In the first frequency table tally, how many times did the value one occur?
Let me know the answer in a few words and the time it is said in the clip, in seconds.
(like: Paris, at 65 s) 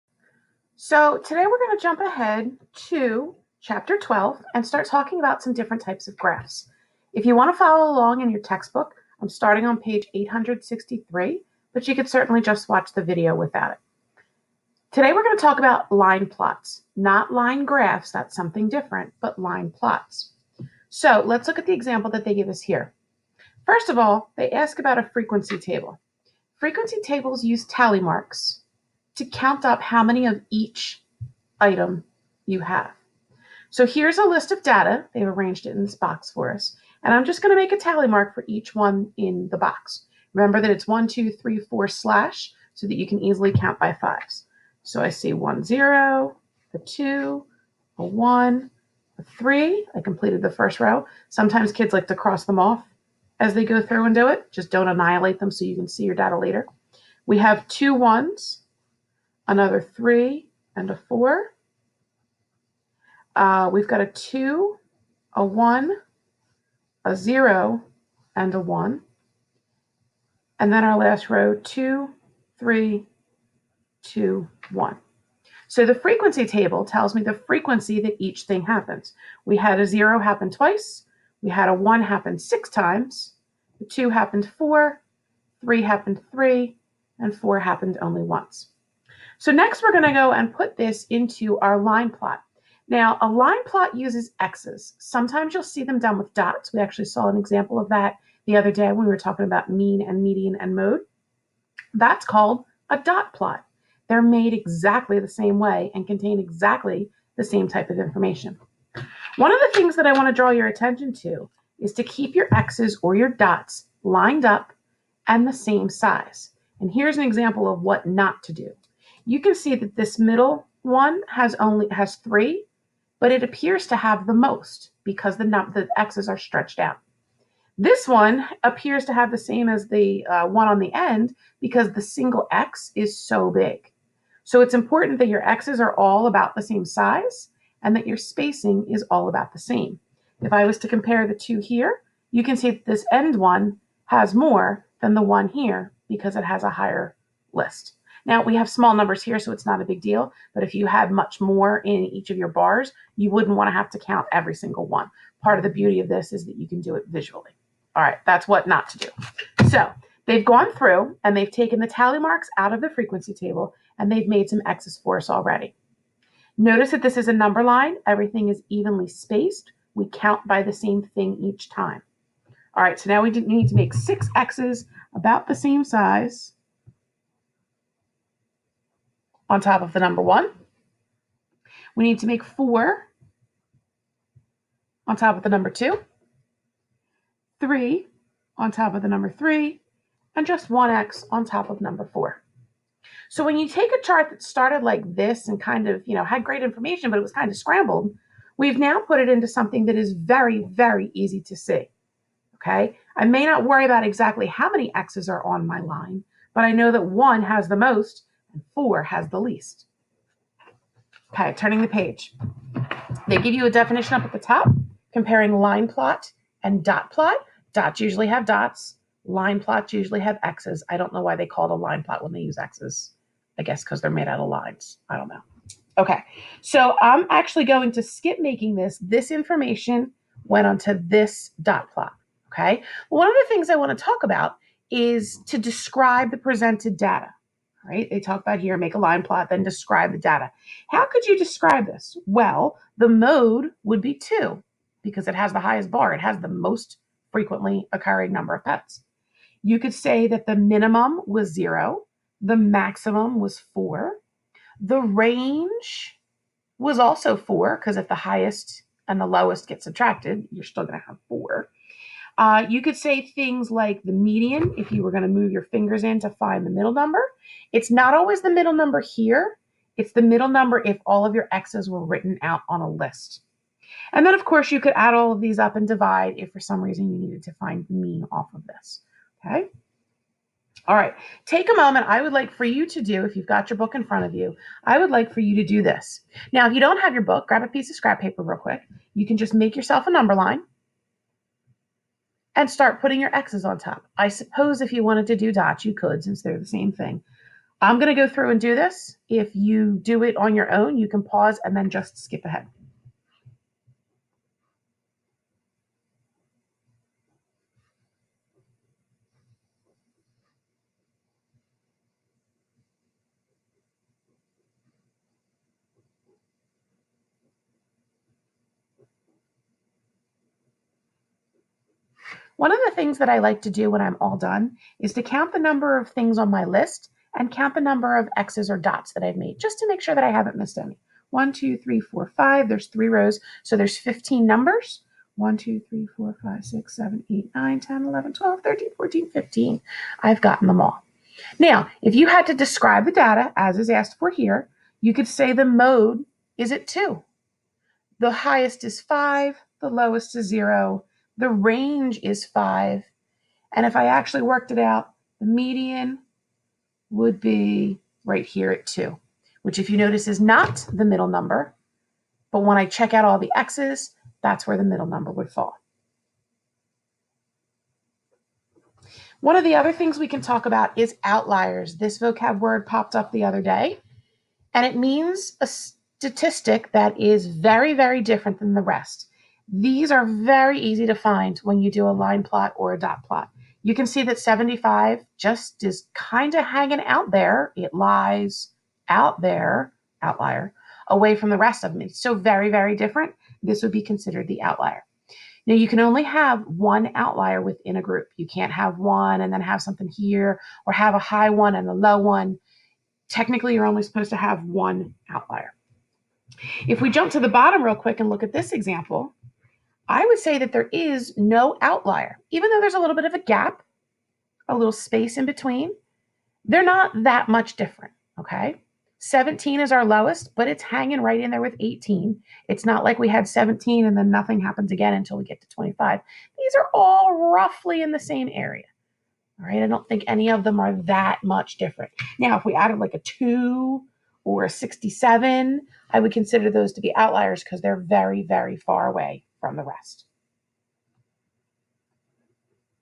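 6, at 82 s.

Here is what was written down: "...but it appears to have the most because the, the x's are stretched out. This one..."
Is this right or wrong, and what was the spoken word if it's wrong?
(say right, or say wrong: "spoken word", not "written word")
right.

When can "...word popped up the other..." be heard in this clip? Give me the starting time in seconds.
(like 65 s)
372 s.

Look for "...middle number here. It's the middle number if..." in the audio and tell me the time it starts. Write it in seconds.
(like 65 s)
268 s.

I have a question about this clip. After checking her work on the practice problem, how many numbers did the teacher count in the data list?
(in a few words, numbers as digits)
15.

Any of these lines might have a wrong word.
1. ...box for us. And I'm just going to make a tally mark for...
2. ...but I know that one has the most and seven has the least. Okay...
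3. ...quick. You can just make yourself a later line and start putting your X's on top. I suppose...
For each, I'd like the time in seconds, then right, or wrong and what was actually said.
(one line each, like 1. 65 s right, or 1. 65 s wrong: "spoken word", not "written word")
1. 35 s right
2. 206 s wrong: "four", not "seven"
3. 288 s wrong: "number", not "later".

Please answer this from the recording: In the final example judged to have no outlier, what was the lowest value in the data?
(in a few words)
17.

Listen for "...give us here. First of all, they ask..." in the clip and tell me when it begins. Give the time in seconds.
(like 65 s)
22 s.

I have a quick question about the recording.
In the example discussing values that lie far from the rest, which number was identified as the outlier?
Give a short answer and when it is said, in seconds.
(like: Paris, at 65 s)
75, at 384 s.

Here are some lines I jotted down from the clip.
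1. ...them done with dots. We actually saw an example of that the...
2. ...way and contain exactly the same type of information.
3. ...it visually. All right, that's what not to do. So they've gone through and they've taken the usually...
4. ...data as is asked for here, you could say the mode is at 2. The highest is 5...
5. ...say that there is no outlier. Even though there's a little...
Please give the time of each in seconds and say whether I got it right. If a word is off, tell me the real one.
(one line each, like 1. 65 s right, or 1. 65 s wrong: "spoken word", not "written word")
1. 95 s right
2. 105 s right
3. 156 s wrong: "tally", not "usually"
4. 343 s right
5. 410 s right.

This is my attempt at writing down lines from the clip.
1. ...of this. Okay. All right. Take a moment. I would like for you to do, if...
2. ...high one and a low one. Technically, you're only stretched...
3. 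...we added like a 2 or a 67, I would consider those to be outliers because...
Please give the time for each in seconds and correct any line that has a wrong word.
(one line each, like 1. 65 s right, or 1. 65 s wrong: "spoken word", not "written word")
1. 278 s right
2. 401 s wrong: "supposed", not "stretched"
3. 432 s right.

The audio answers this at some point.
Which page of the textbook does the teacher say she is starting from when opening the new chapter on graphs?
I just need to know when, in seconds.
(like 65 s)
10 s.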